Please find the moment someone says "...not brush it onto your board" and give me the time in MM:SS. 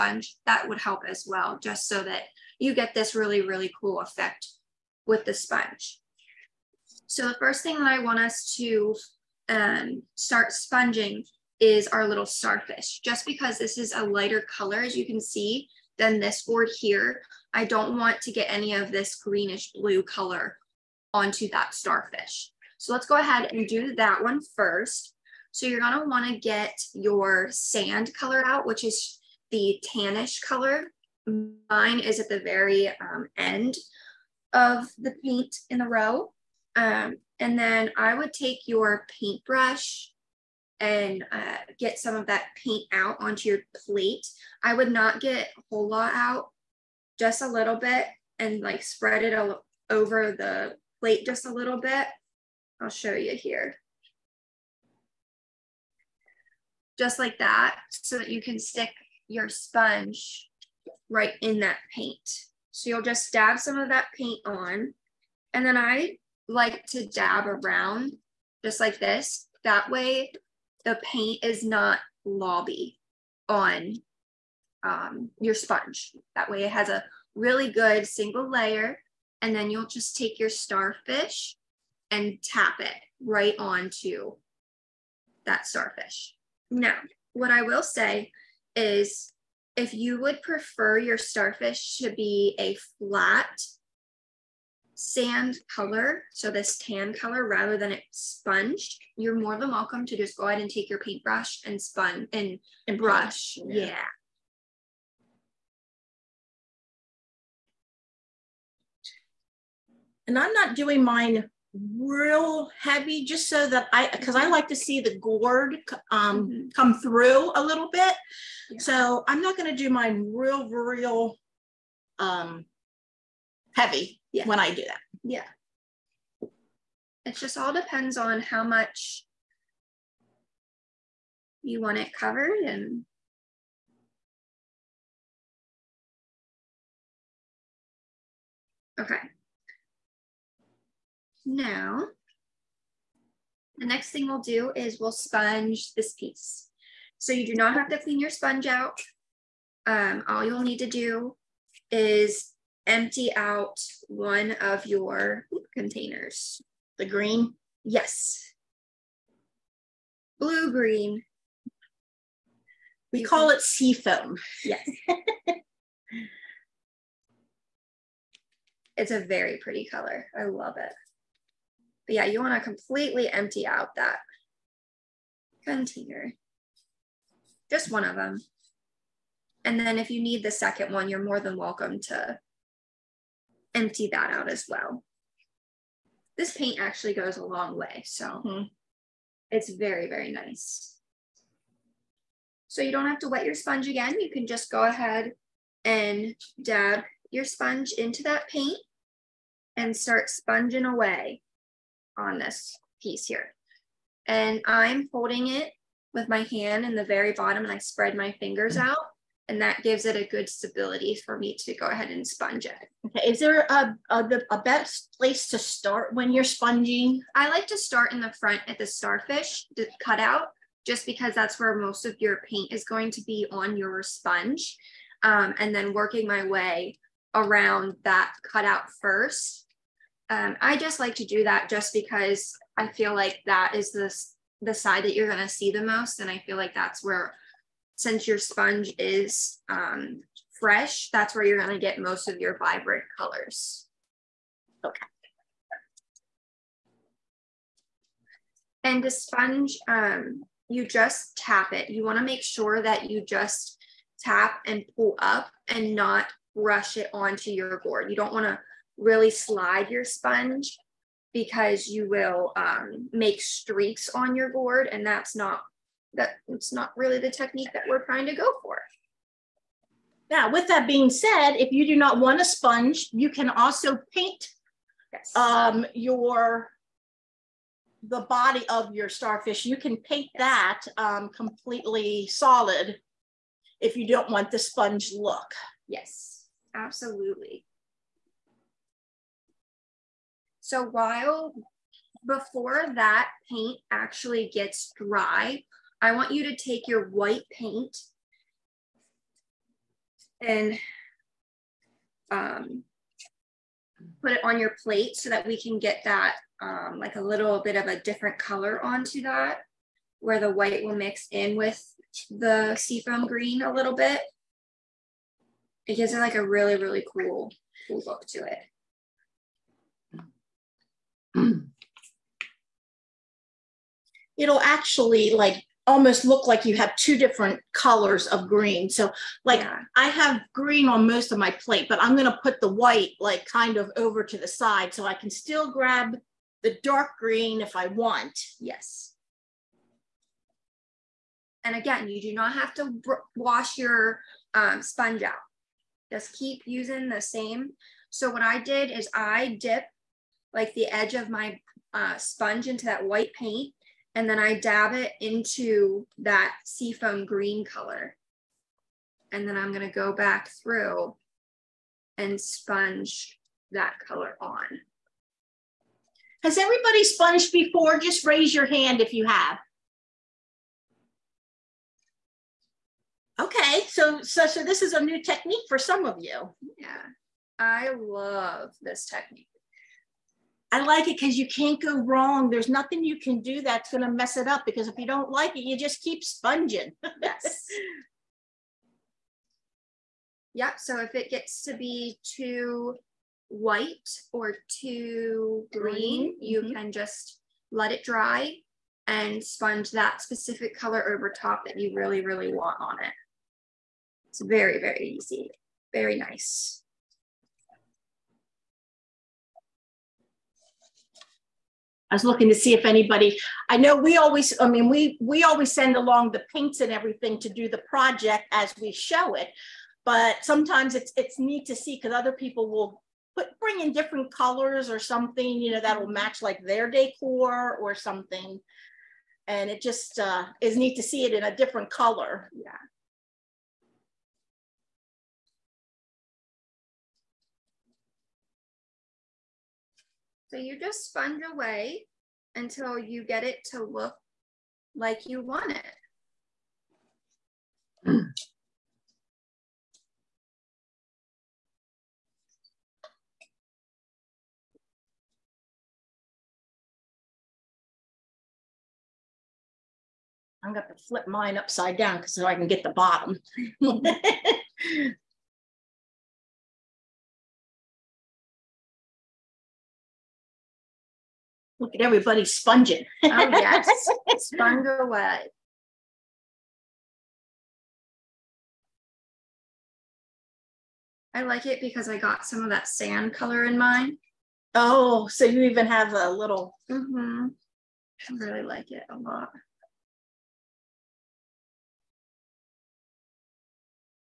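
04:15.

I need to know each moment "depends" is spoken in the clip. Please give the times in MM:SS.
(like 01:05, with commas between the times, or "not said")
02:07.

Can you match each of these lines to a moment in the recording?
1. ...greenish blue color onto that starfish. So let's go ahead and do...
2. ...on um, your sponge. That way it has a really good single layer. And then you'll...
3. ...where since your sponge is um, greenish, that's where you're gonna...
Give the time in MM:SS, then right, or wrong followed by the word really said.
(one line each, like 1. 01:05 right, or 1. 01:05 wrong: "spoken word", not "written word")
1. 00:19 right
2. 01:13 right
3. 03:57 wrong: "fresh", not "greenish".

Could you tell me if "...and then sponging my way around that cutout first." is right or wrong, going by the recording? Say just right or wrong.
wrong.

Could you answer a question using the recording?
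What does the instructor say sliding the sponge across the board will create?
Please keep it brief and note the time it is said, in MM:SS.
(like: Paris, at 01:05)
streaks, at 04:23.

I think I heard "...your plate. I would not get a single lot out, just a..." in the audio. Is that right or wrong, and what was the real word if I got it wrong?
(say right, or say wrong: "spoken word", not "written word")
wrong: "whole", not "single".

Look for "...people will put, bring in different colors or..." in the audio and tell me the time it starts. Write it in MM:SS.
07:02.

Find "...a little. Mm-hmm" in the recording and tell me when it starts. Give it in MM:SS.
08:06.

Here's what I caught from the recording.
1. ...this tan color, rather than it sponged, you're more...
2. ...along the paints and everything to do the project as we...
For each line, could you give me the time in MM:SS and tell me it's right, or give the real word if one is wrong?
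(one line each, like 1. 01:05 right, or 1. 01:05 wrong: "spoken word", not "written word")
1. 01:36 right
2. 06:55 right.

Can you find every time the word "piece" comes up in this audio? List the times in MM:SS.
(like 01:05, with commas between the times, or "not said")
02:26, 03:23.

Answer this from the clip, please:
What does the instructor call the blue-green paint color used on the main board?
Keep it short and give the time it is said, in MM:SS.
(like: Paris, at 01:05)
sea foam, at 02:43.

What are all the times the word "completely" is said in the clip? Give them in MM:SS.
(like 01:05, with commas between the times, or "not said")
02:52, 04:41.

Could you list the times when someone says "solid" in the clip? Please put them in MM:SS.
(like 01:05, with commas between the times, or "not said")
04:42.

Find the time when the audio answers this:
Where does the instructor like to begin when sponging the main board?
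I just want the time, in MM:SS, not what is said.
03:38.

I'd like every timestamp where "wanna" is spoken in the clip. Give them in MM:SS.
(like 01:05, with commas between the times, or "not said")
00:26, 04:12, 04:18.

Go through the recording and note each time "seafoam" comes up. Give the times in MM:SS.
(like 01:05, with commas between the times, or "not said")
05:12, 05:56.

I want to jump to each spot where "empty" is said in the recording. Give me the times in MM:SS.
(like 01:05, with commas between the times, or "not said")
02:32, 02:53, 03:03.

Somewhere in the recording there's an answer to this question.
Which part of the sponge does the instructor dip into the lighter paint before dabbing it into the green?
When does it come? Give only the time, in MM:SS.
05:50.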